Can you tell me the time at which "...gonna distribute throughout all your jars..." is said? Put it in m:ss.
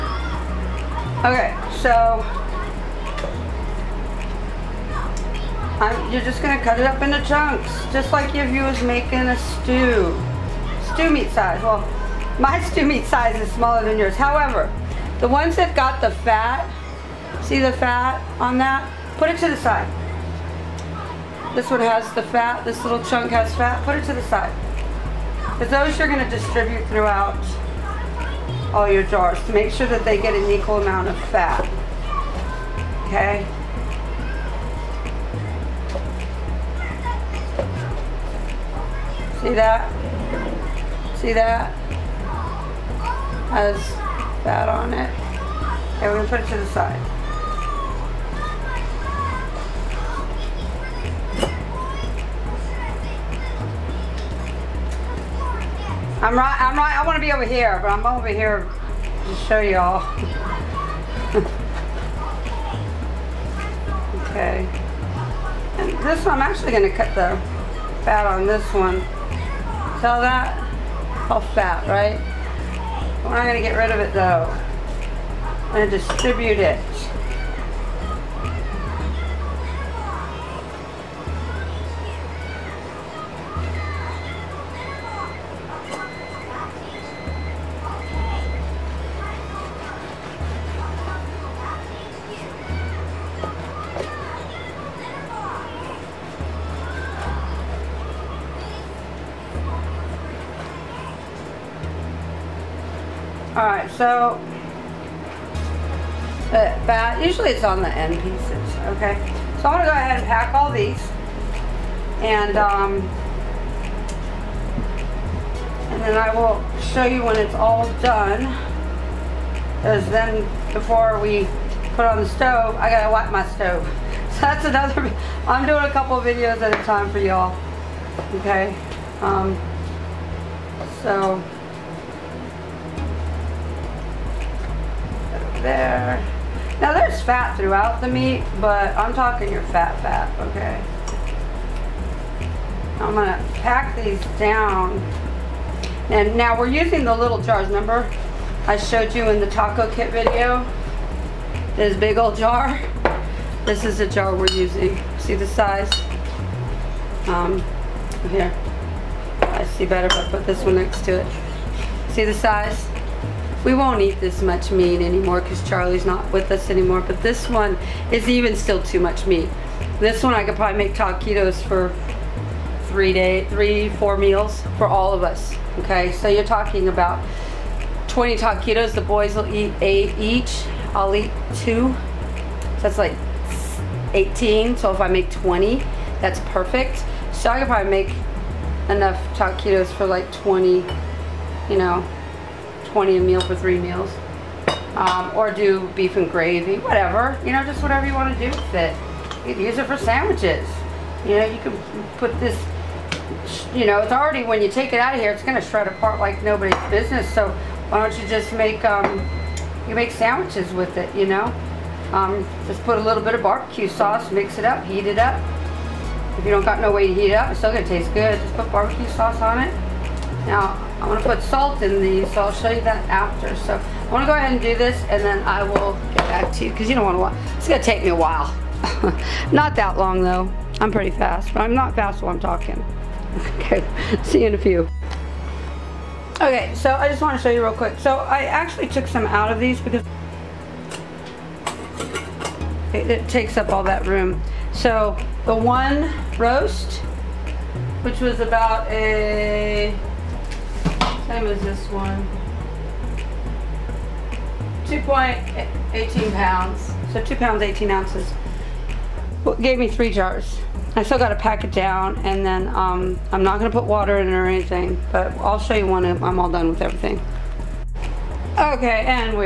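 0:26.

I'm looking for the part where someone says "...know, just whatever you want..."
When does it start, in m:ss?
3:17.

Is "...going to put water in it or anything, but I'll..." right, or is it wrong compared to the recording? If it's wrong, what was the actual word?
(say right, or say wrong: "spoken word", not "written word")
right.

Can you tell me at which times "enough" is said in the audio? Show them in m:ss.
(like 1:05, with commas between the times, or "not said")
3:08.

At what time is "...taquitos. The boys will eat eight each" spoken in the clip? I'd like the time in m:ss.
2:58.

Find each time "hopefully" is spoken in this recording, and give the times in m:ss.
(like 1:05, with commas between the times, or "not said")
not said.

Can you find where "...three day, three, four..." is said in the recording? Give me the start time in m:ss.
2:52.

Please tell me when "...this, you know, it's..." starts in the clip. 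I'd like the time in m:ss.
3:22.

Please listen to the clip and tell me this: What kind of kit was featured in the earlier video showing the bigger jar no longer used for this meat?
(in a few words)
taco kit.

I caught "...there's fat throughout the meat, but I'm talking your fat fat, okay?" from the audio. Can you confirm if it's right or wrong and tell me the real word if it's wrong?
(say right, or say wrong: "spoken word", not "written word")
right.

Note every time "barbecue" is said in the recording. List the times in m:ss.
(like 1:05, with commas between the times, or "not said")
3:33, 3:38.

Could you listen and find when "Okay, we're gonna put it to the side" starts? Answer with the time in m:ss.
0:45.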